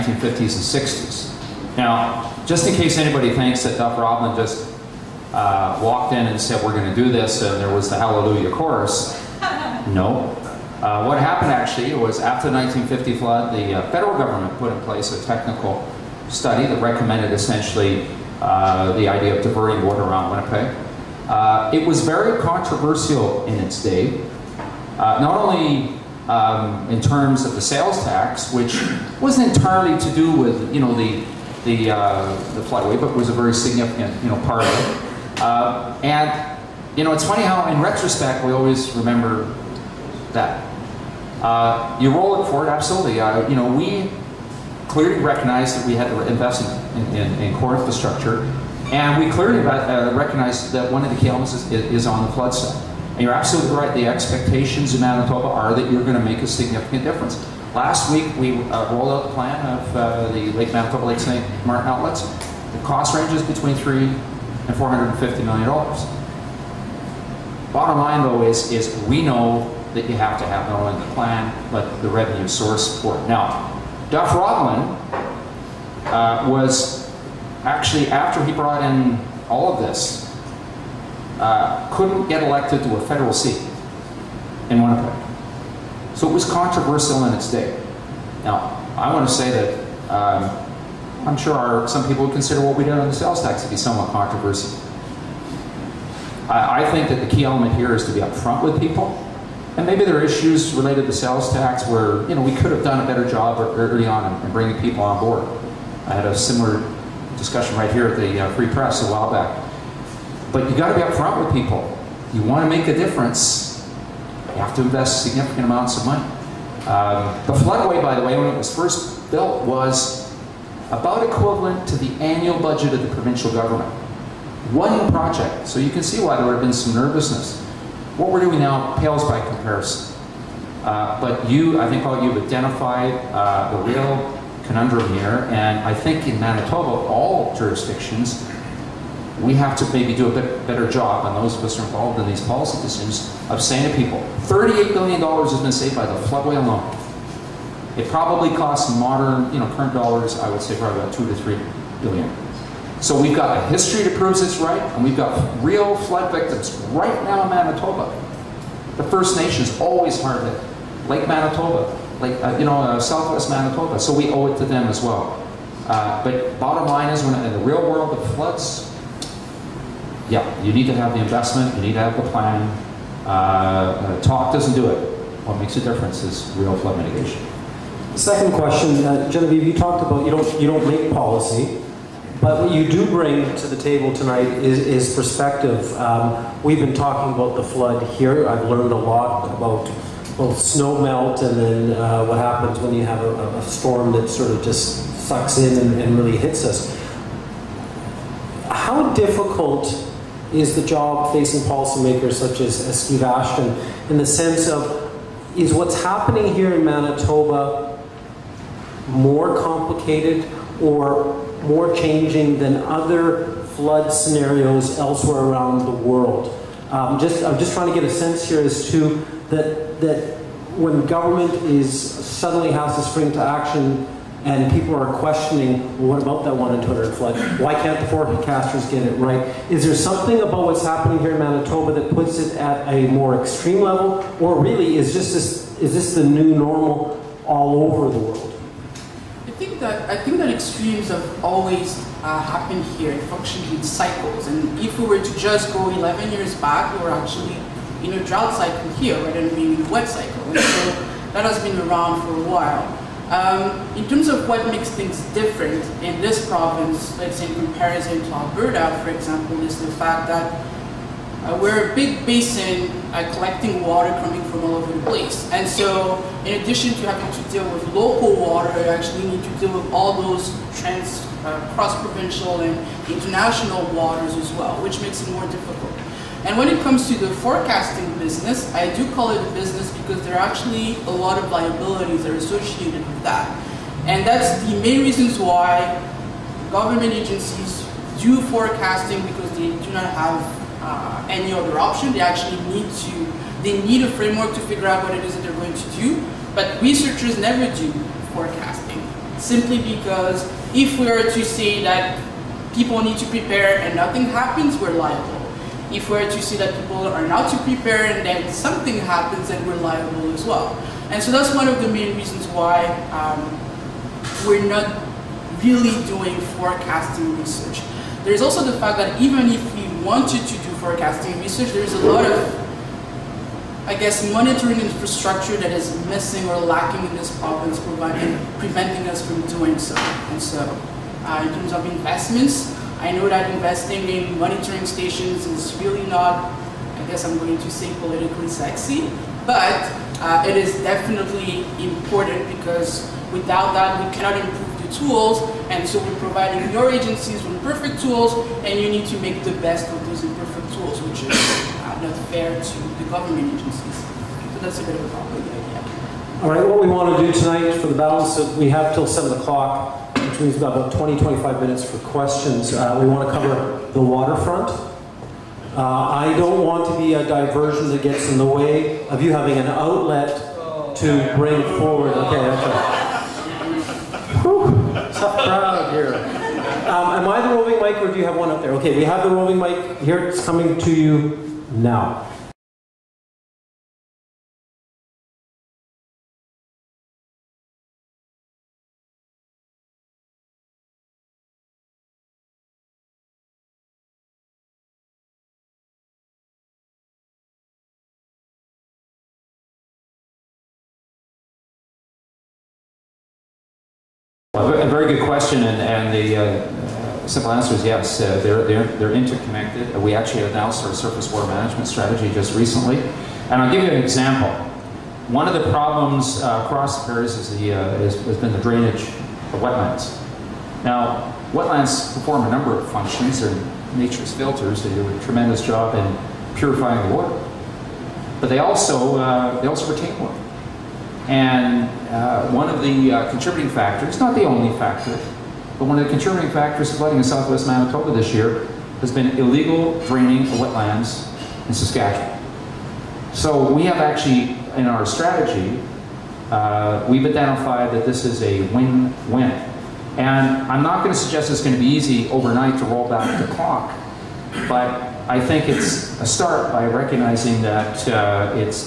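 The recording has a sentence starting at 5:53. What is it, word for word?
So that's a bit of a problem.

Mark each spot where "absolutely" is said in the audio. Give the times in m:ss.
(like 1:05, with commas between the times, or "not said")
0:42, 0:53.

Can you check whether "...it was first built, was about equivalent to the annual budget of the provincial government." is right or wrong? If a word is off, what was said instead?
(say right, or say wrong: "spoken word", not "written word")
right.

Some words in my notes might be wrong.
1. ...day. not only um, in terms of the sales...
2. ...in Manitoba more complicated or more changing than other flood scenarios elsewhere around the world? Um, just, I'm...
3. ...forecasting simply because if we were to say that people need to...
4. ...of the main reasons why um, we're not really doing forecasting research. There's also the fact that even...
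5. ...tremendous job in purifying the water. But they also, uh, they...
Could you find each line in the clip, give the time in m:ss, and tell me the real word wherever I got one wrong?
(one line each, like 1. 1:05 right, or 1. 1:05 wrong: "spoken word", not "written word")
1. 0:23 right
2. 3:26 right
3. 4:58 right
4. 5:11 right
5. 7:05 right.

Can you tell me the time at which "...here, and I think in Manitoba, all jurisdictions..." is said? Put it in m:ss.
2:15.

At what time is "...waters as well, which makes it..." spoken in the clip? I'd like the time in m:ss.
4:33.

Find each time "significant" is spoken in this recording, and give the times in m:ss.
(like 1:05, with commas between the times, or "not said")
0:33, 0:56, 1:55.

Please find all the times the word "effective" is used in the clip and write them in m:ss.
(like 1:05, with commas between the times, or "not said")
not said.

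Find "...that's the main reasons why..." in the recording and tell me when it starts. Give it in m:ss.
4:44.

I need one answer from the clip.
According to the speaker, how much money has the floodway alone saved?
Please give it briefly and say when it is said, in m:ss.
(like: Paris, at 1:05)
$38 billion, at 2:24.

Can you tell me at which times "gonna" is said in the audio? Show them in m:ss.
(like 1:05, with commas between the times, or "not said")
not said.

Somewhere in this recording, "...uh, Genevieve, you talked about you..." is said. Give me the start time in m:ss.
2:59.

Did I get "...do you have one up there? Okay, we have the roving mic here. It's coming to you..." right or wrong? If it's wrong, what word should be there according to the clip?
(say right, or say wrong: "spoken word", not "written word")
right.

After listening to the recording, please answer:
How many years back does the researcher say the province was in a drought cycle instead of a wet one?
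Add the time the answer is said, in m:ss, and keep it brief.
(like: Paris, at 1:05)
11 years, at 4:05.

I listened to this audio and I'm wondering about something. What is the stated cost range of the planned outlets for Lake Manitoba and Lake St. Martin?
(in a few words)
$300 to $450 million.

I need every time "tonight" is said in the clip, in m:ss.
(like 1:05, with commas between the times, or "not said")
3:04, 5:57.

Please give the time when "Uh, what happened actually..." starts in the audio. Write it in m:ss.
0:10.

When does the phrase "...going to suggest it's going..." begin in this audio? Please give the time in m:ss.
7:31.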